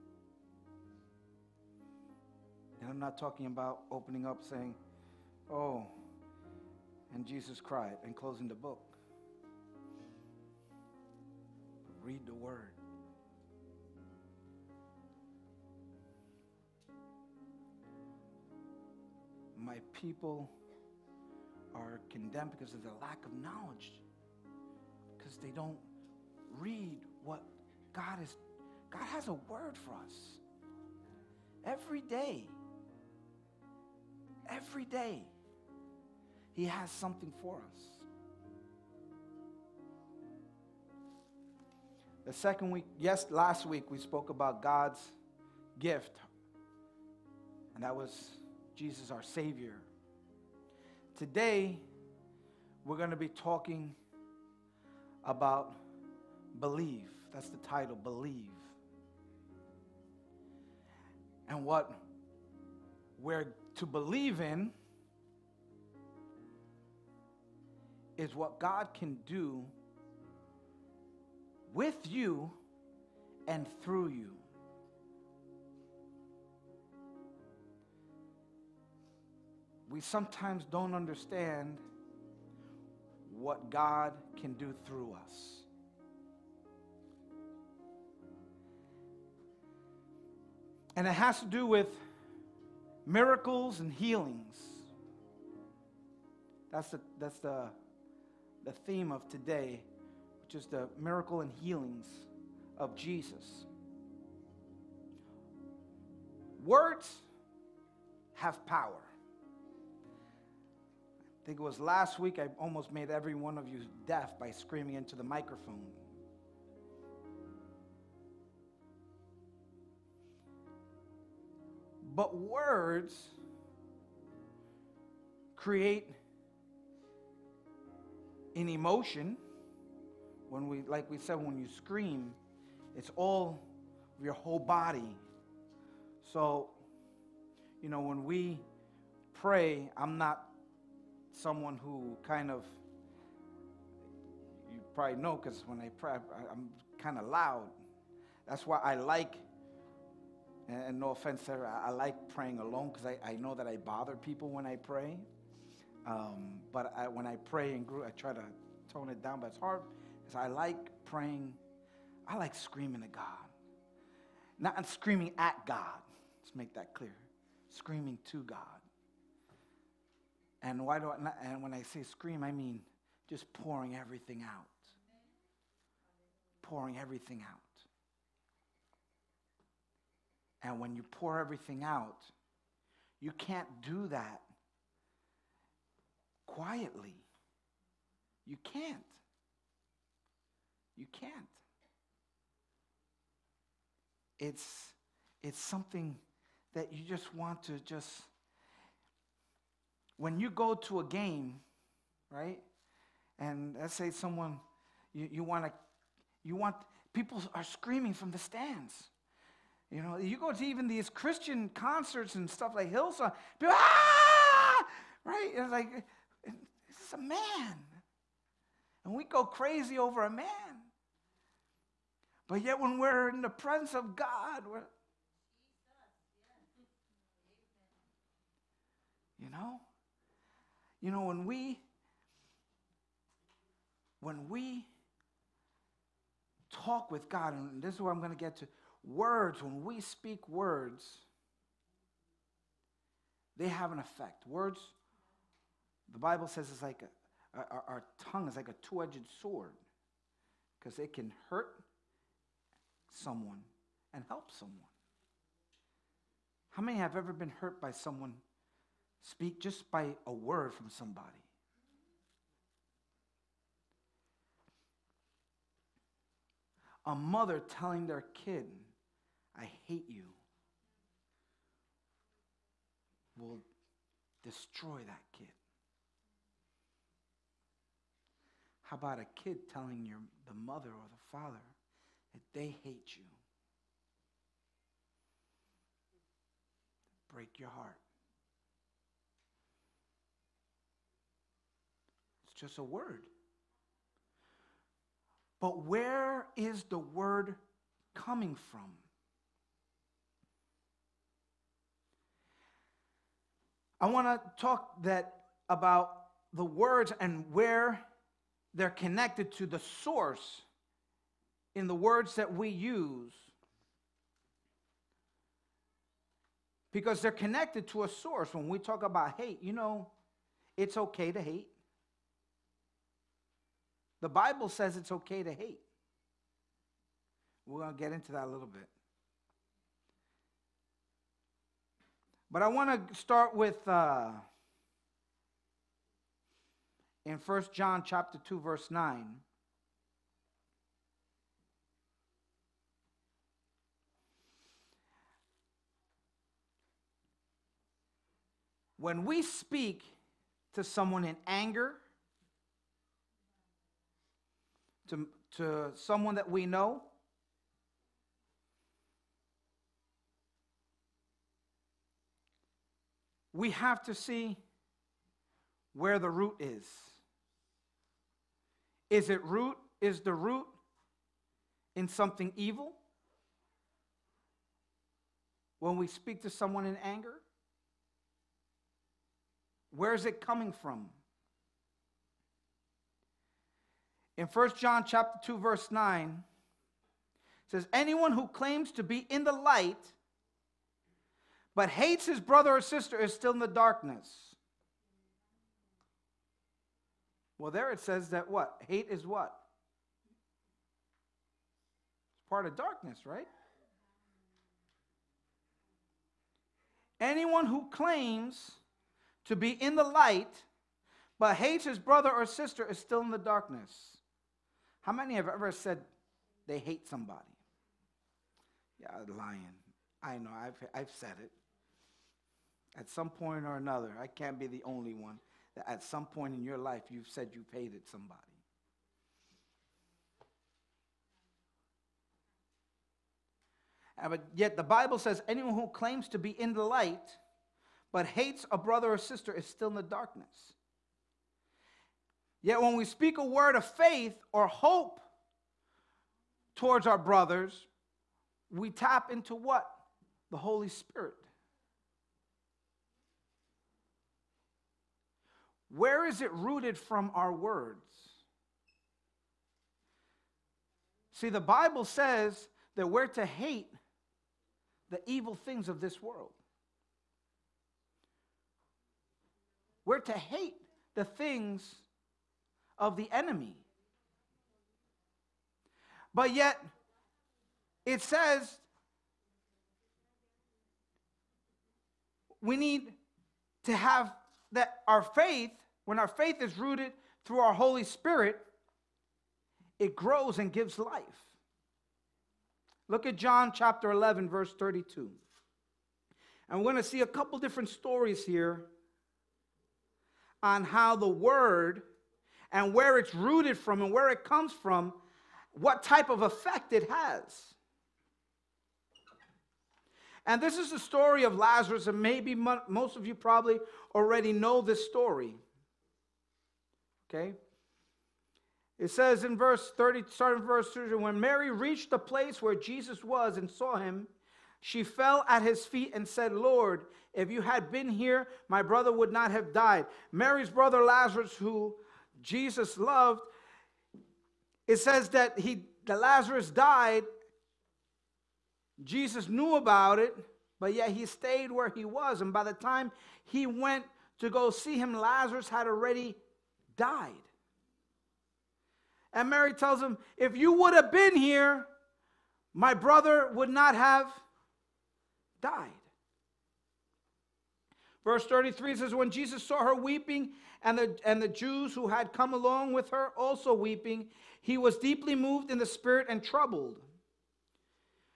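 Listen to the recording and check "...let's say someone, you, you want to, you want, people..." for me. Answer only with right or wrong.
right.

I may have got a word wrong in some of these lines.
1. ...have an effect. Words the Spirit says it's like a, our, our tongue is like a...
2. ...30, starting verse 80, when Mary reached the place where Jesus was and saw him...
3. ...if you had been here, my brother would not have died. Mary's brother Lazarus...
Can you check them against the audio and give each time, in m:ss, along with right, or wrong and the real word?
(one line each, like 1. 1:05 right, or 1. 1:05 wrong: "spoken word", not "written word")
1. 4:03 wrong: "Bible", not "Spirit"
2. 8:39 wrong: "30", not "80"
3. 8:47 right.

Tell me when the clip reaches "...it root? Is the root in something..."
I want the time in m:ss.
6:09.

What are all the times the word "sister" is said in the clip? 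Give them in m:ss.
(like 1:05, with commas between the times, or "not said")
6:32, 6:52, 7:19.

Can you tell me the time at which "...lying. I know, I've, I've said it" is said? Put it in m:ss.
6:59.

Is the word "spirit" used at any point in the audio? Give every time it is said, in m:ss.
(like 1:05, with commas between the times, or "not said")
7:30, 8:08, 9:25.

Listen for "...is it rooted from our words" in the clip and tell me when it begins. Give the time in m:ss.
7:36.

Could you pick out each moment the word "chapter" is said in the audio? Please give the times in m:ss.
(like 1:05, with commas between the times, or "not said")
5:38, 6:25, 8:13.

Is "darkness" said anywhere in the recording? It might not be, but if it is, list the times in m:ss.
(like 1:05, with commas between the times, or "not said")
6:33, 6:42, 6:53, 7:20.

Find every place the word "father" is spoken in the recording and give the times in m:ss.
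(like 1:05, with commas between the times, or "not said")
4:41.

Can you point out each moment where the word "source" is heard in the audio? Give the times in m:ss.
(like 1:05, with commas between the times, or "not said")
5:09, 5:18.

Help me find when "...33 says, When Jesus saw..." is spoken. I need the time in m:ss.
9:18.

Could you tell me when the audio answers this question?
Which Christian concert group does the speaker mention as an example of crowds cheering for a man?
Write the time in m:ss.
3:32.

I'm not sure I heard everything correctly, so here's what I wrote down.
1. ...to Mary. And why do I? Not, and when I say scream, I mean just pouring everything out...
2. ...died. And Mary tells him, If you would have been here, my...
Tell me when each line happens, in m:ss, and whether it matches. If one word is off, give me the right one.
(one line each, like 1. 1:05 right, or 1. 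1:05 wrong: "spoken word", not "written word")
1. 2:48 wrong: "God", not "Mary"
2. 9:06 right.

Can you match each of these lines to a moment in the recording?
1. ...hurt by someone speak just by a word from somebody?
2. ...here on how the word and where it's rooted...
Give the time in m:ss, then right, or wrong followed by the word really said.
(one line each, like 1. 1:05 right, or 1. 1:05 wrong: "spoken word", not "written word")
1. 4:17 right
2. 8:18 right.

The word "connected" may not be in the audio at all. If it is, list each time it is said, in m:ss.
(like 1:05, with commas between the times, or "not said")
5:08, 5:17.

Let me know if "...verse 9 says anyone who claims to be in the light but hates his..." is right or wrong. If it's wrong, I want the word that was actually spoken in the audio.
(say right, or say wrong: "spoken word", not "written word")
right.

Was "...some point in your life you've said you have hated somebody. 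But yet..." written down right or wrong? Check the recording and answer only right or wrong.
right.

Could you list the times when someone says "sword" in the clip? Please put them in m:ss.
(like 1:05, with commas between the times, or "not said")
4:09.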